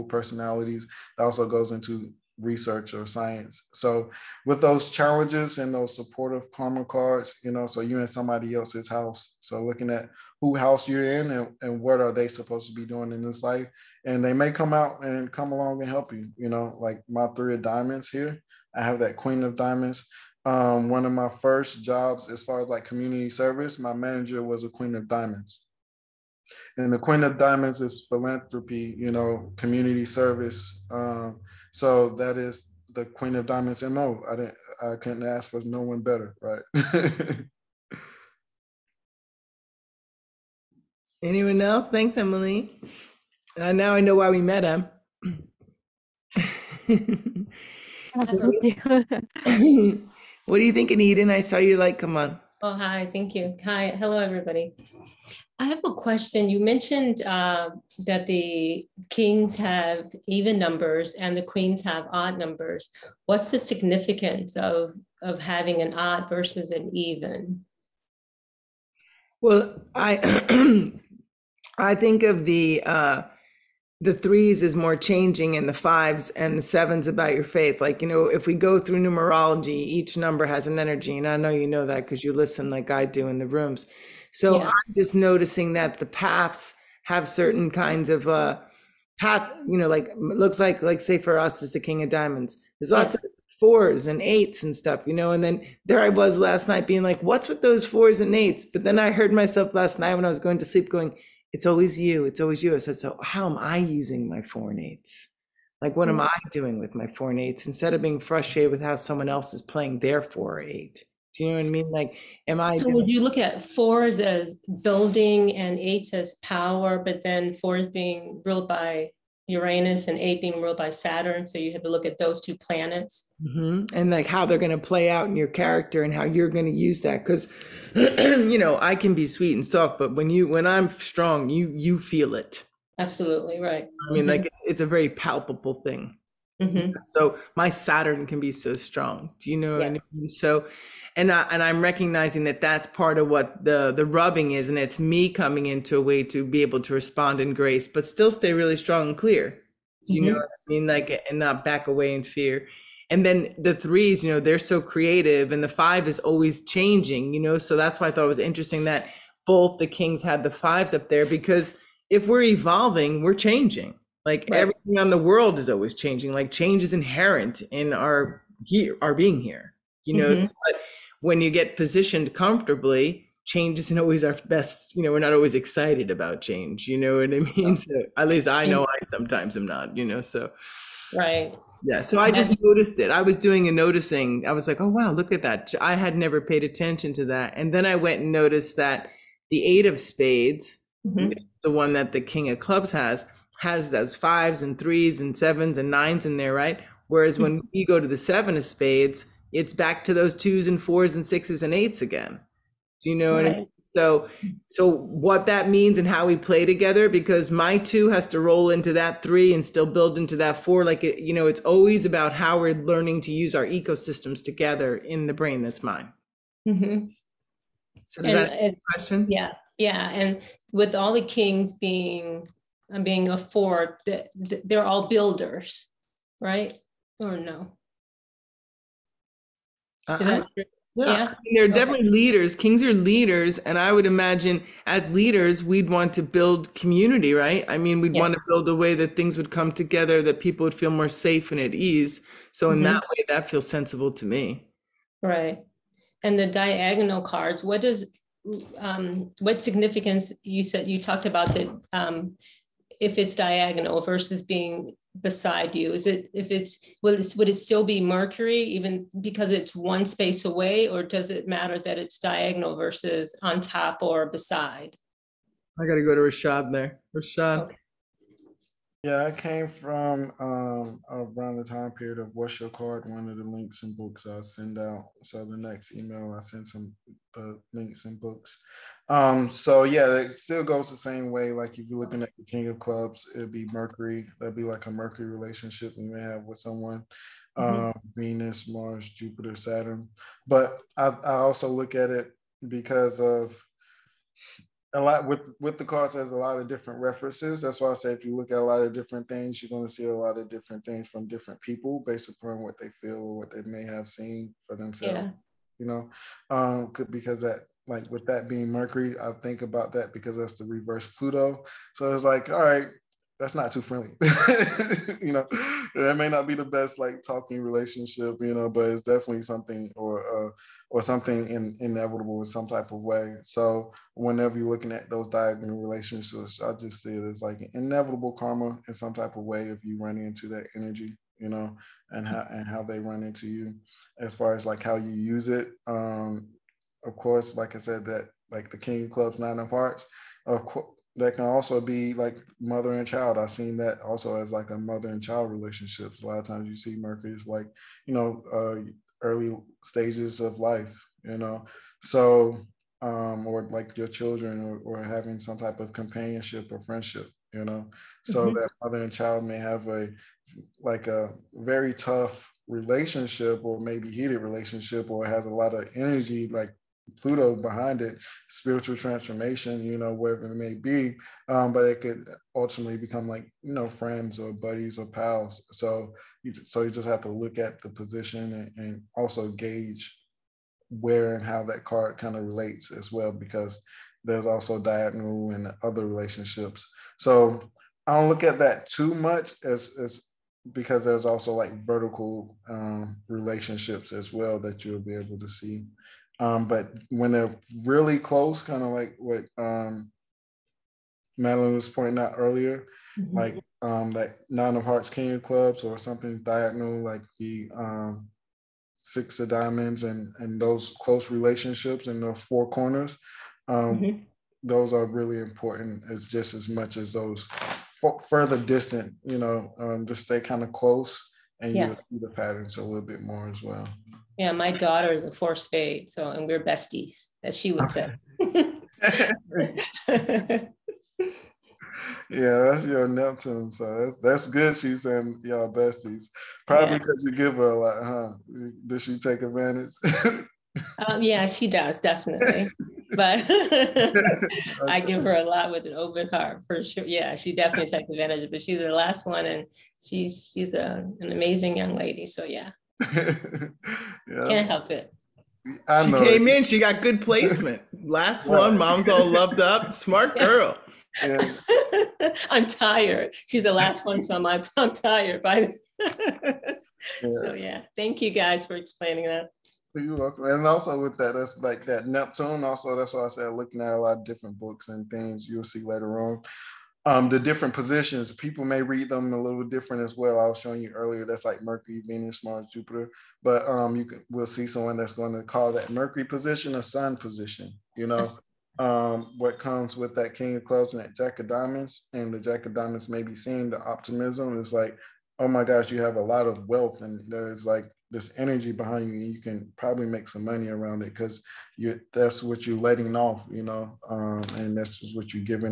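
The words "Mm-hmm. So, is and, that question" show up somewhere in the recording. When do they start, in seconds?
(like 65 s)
216 s.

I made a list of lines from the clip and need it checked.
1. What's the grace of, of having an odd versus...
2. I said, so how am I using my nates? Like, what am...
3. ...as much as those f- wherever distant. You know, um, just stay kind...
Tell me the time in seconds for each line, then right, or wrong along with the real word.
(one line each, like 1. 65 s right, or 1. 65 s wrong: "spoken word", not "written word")
1. 63 s wrong: "significance", not "grace"
2. 102 s right
3. 416 s wrong: "further", not "wherever".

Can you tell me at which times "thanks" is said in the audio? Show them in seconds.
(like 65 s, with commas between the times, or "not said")
41 s, 53 s, 467 s.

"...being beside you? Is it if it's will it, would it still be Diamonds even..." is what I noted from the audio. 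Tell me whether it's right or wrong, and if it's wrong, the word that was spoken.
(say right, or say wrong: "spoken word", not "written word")
wrong: "Mercury", not "Diamonds".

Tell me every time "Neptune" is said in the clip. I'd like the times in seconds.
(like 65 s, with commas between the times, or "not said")
433 s, 472 s.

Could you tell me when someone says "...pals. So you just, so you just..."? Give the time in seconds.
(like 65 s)
375 s.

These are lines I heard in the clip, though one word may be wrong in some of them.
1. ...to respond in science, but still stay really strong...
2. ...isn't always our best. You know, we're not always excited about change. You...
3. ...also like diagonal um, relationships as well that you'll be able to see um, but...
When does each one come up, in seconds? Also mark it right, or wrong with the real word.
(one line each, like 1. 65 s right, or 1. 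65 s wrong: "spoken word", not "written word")
1. 146 s wrong: "grace", not "science"
2. 173 s right
3. 391 s wrong: "vertical", not "diagonal".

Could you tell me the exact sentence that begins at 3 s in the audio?
So with those challenges and those supportive karma cards, you know, so you're in somebody else's house.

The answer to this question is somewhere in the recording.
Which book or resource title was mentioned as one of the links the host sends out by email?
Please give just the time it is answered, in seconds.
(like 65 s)
272 s.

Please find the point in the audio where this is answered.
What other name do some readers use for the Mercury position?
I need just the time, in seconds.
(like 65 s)
486 s.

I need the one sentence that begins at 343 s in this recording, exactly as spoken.
I've seen that also as like a mother and child relationships.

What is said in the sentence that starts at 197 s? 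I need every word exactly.
Whereas when we go to the seven of spades, it's back to those twos and fours and sixes and eights again.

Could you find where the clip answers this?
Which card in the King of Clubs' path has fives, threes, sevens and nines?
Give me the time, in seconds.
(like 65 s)
189 s.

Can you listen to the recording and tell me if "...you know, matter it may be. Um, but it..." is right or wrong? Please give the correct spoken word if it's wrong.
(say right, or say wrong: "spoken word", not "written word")
wrong: "wherever", not "matter".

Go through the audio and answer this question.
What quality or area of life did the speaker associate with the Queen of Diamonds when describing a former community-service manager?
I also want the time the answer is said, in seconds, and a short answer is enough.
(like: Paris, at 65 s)
Philanthropy, at 28 s.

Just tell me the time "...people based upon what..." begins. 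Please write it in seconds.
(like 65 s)
301 s.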